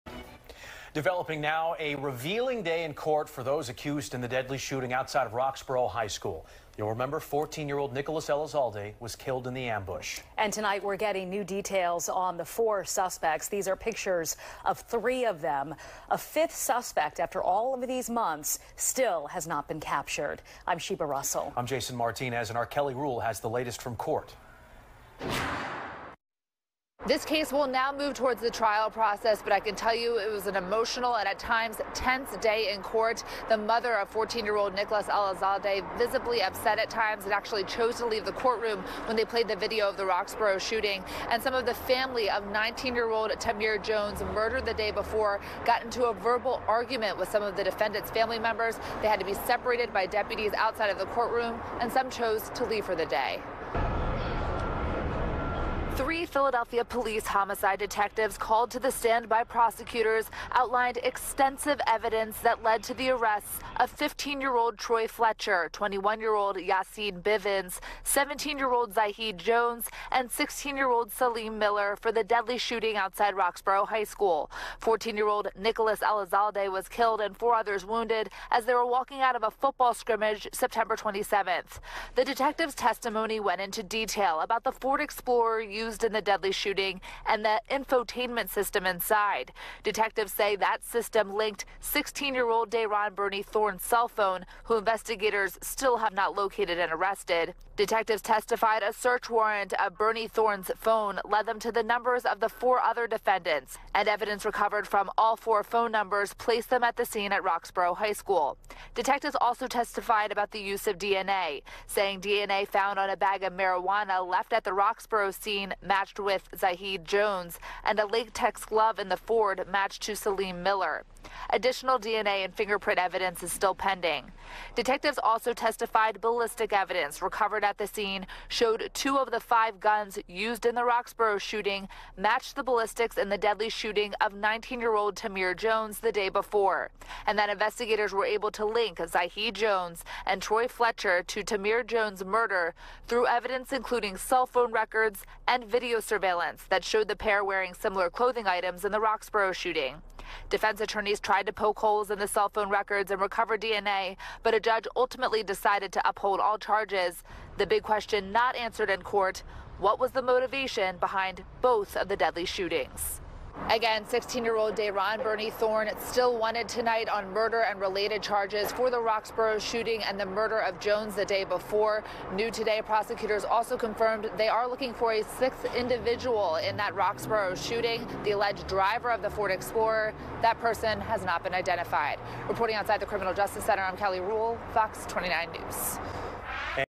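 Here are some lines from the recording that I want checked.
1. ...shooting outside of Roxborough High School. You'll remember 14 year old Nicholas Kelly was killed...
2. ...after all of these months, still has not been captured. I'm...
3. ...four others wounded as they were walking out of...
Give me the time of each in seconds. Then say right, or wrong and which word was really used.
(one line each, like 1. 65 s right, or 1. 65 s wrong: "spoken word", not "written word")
1. 4 s wrong: "Elizalde", not "Kelly"
2. 17 s right
3. 77 s right.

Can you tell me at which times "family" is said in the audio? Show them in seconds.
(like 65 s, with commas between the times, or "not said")
41 s, 48 s.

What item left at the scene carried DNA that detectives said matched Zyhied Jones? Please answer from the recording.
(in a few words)
A bag of marijuana.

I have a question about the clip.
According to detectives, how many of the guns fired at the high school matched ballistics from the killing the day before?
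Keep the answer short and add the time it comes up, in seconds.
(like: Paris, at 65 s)
2, at 128 s.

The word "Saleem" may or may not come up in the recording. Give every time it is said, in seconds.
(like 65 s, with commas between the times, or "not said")
71 s, 120 s.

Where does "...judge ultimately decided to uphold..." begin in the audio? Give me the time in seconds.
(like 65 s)
154 s.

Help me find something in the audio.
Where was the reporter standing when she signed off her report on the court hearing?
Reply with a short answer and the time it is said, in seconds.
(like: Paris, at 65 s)
Criminal Justice Center, at 183 s.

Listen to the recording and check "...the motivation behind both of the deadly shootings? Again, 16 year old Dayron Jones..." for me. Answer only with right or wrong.
wrong.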